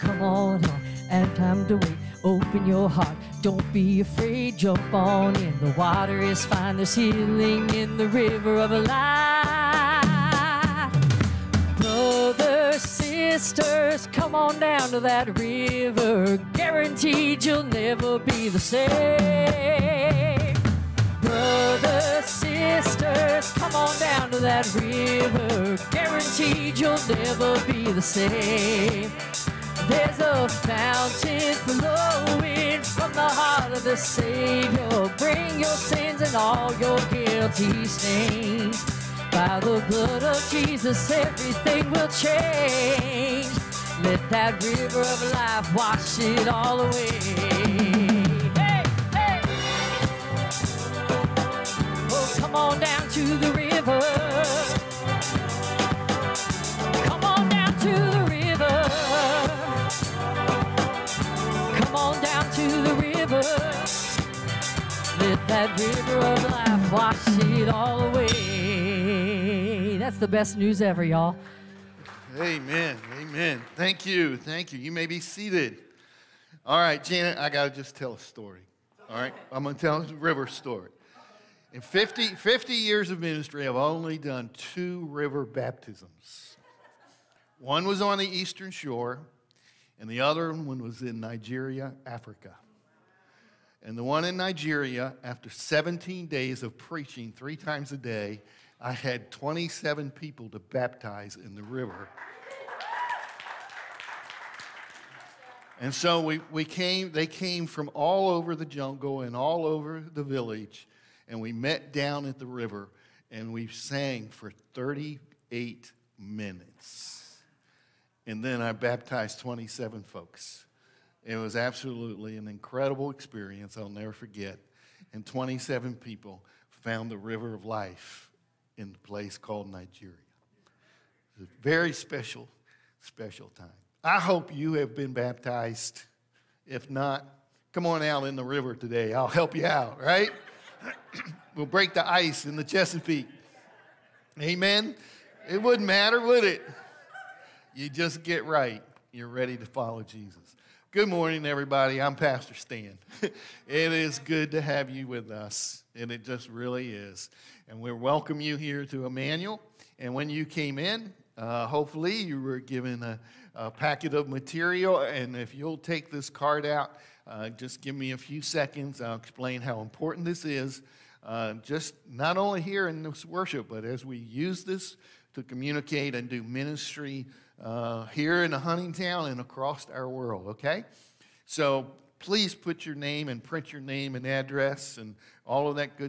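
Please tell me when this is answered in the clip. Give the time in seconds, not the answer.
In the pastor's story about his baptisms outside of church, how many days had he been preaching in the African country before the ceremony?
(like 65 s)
95 s.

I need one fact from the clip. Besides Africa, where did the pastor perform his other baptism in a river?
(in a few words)
the eastern shore.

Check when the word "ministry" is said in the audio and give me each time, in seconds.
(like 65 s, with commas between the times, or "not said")
83 s, 176 s.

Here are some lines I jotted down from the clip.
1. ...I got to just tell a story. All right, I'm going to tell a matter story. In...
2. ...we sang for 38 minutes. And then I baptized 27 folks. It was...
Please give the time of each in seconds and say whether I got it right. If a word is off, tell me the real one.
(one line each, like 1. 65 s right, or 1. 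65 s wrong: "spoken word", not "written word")
1. 77 s wrong: "river", not "matter"
2. 113 s right.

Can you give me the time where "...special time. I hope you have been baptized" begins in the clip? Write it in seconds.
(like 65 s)
133 s.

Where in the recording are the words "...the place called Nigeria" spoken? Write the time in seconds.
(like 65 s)
128 s.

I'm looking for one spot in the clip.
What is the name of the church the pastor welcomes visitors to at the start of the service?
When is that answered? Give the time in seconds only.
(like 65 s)
159 s.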